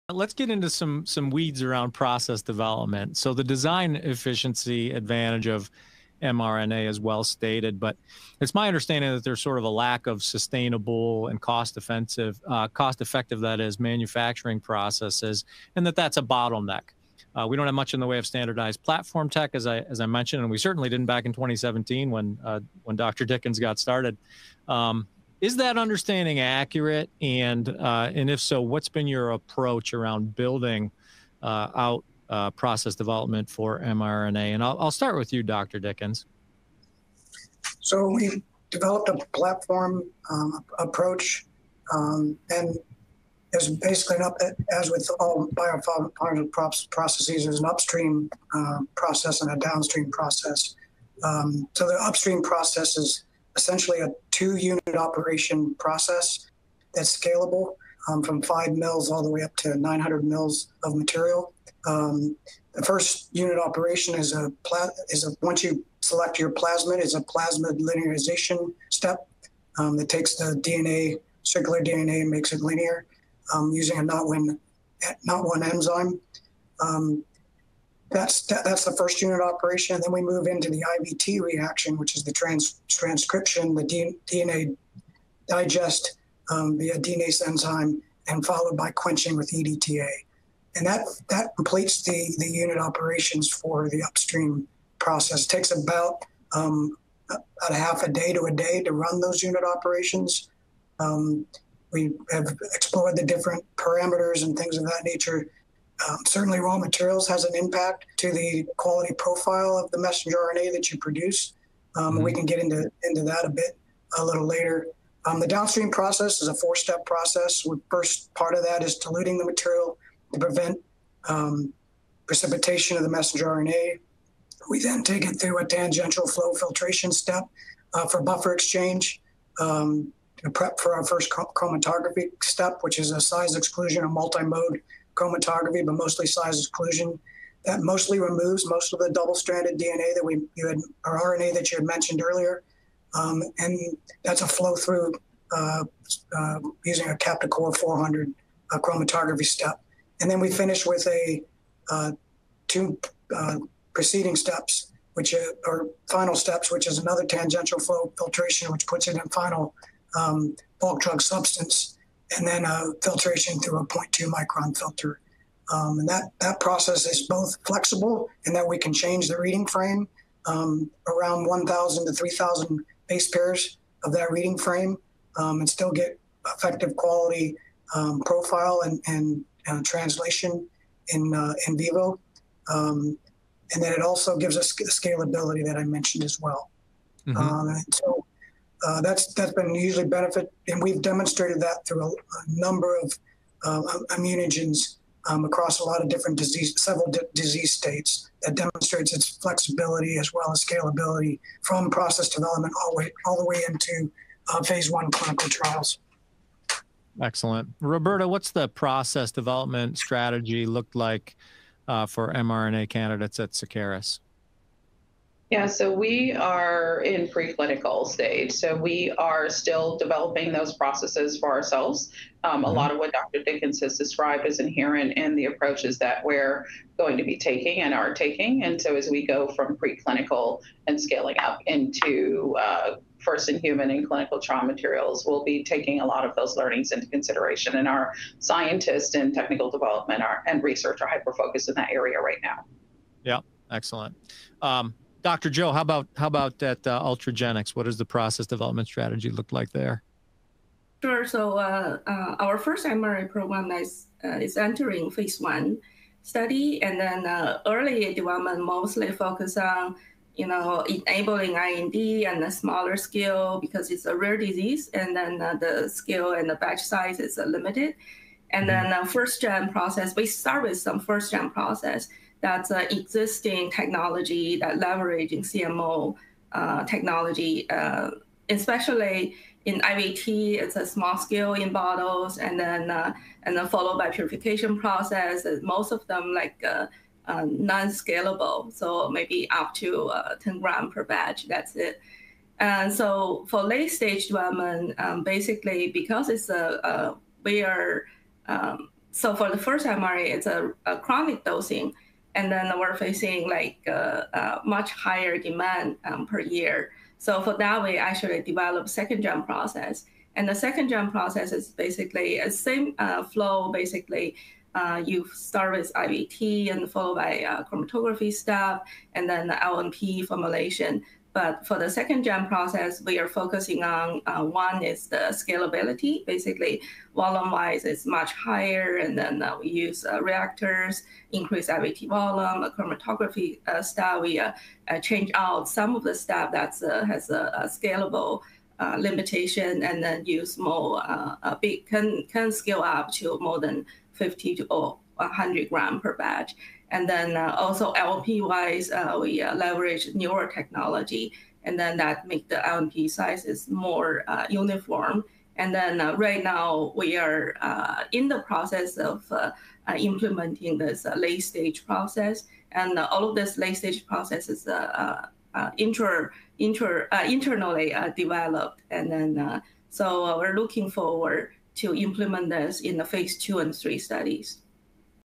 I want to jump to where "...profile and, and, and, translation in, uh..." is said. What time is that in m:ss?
2:58.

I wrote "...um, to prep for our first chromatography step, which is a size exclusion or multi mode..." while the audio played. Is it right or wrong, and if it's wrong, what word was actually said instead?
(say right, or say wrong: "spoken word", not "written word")
right.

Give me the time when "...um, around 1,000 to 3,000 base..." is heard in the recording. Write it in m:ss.
2:50.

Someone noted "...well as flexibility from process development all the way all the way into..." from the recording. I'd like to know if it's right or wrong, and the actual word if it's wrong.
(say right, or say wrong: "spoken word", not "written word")
wrong: "scalability", not "flexibility".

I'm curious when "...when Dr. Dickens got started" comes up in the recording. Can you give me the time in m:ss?
0:22.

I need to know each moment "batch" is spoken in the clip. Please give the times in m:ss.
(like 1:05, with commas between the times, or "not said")
4:26, 4:51, 5:46.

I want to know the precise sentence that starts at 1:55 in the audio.
Um, the downstream process is a four step process.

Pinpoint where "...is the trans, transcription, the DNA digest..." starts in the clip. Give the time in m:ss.
1:22.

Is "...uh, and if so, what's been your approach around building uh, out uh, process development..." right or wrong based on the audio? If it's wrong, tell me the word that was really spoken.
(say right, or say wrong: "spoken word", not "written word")
right.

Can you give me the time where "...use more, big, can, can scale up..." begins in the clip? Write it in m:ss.
5:40.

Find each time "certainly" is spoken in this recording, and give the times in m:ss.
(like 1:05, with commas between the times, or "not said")
0:20, 1:46.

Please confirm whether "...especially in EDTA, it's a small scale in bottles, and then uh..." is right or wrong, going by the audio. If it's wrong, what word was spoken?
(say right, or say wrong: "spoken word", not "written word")
wrong: "IVT", not "EDTA".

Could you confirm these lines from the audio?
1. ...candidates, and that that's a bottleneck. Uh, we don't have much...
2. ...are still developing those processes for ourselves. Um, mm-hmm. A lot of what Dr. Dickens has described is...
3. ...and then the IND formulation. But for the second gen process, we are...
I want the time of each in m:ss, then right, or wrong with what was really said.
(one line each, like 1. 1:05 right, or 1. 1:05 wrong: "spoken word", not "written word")
1. 0:14 wrong: "processes", not "candidates"
2. 3:39 right
3. 5:19 wrong: "LNP", not "IND".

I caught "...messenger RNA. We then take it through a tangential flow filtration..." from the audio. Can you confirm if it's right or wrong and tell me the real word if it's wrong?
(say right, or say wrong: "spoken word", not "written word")
right.